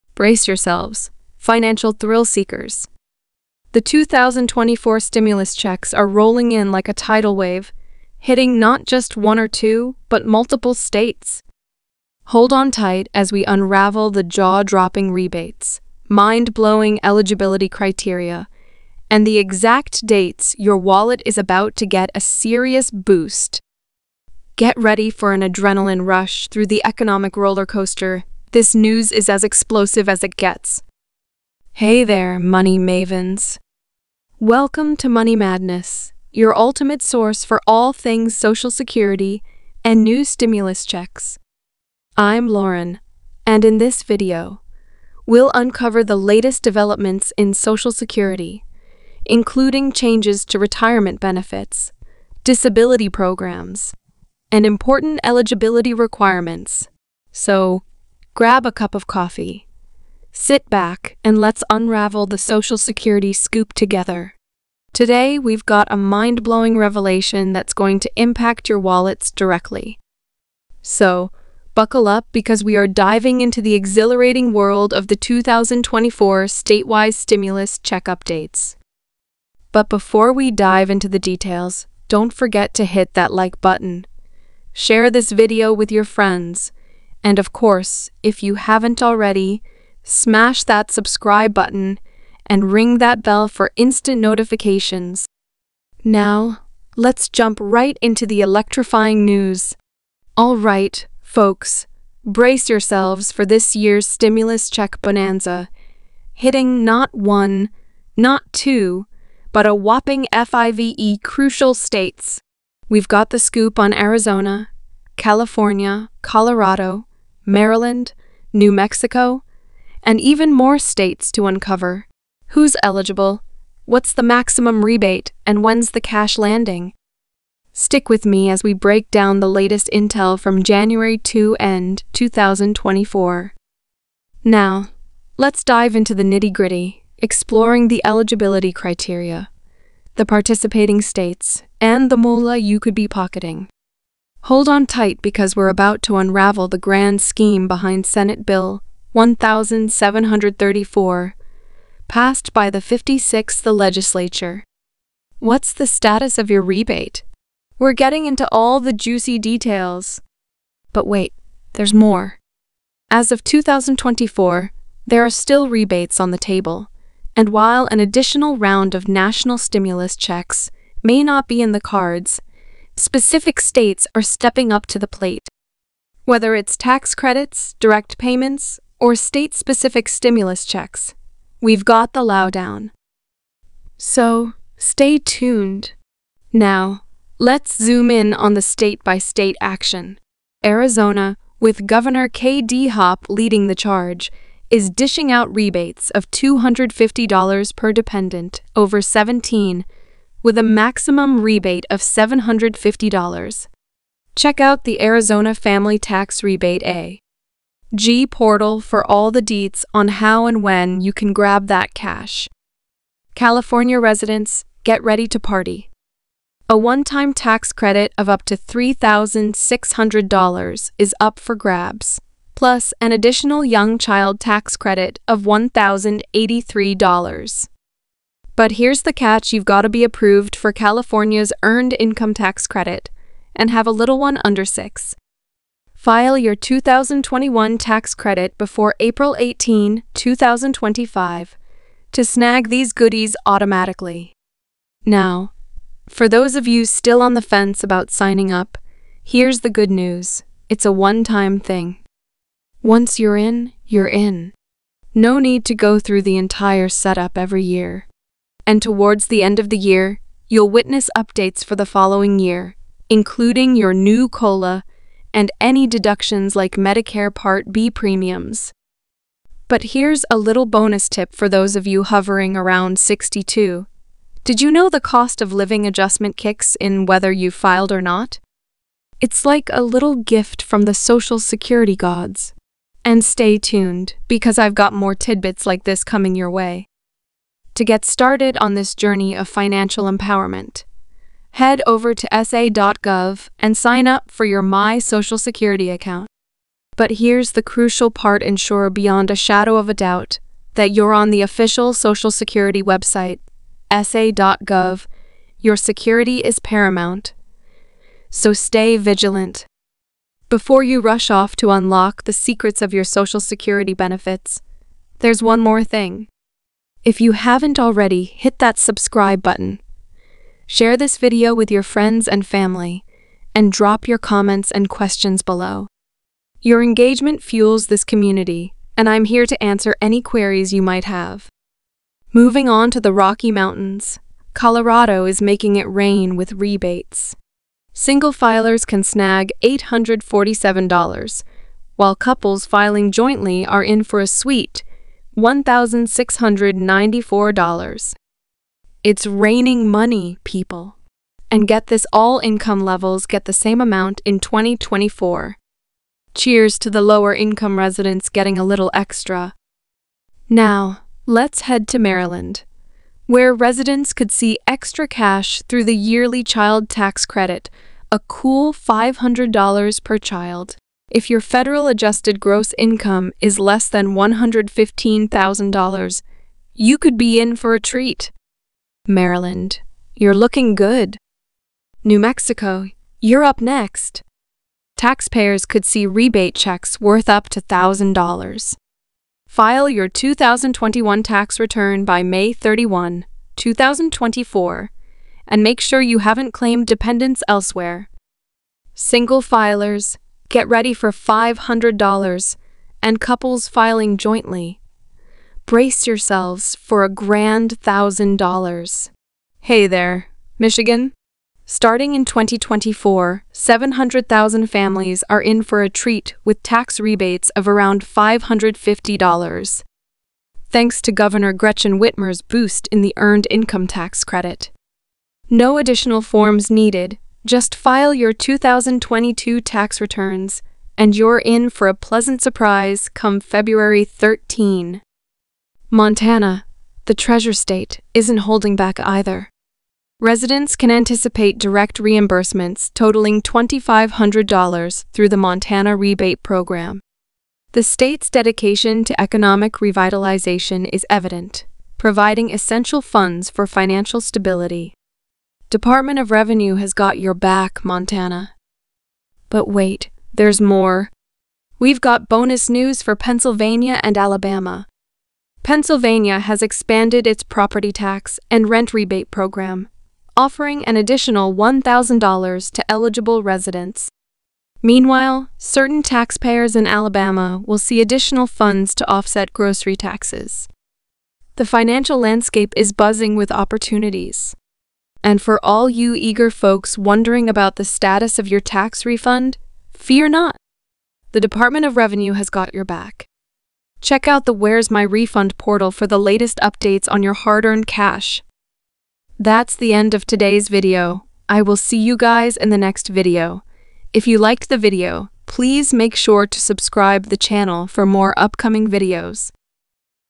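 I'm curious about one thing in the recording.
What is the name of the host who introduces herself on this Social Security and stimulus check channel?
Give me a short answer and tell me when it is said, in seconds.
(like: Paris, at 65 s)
Lauren, at 42 s.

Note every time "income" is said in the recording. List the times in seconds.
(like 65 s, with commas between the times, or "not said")
231 s, 352 s, 357 s, 372 s, 423 s.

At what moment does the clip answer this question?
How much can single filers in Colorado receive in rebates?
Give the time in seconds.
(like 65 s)
339 s.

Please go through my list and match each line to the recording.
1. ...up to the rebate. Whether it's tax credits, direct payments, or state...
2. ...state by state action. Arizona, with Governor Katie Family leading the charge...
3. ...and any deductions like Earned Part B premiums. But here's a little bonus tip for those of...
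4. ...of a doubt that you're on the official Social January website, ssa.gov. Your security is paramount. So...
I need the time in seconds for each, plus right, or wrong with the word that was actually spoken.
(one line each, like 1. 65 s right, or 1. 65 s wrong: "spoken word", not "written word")
1. 174 s wrong: "plate", not "rebate"
2. 188 s wrong: "Hobbs", not "Family"
3. 265 s wrong: "Medicare", not "Earned"
4. 299 s wrong: "Security", not "January".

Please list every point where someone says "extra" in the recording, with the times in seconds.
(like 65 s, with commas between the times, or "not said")
358 s, 364 s.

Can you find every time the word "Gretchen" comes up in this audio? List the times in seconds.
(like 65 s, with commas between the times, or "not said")
421 s.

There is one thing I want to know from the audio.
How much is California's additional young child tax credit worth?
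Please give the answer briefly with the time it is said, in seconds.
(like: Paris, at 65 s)
$1,083, at 225 s.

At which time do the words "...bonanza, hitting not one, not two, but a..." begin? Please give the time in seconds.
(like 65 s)
105 s.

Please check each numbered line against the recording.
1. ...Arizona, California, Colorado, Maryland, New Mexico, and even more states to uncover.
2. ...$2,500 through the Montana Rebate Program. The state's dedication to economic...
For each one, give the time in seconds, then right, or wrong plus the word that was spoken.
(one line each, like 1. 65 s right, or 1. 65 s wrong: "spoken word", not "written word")
1. 113 s right
2. 443 s right.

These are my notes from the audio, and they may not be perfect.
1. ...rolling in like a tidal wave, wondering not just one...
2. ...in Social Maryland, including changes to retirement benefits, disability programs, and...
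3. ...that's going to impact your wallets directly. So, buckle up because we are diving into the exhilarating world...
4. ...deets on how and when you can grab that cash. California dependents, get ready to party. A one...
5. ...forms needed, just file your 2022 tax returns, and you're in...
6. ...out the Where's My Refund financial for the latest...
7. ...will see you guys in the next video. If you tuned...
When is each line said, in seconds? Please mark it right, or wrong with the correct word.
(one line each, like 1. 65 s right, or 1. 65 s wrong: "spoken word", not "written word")
1. 6 s wrong: "hitting", not "wondering"
2. 47 s wrong: "Security", not "Maryland"
3. 67 s right
4. 209 s wrong: "residents", not "dependents"
5. 426 s right
6. 494 s wrong: "portal", not "financial"
7. 501 s wrong: "liked", not "tuned".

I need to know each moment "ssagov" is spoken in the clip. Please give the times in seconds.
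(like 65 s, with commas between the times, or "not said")
292 s, 303 s.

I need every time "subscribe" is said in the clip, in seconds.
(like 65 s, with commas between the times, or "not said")
90 s, 318 s, 506 s.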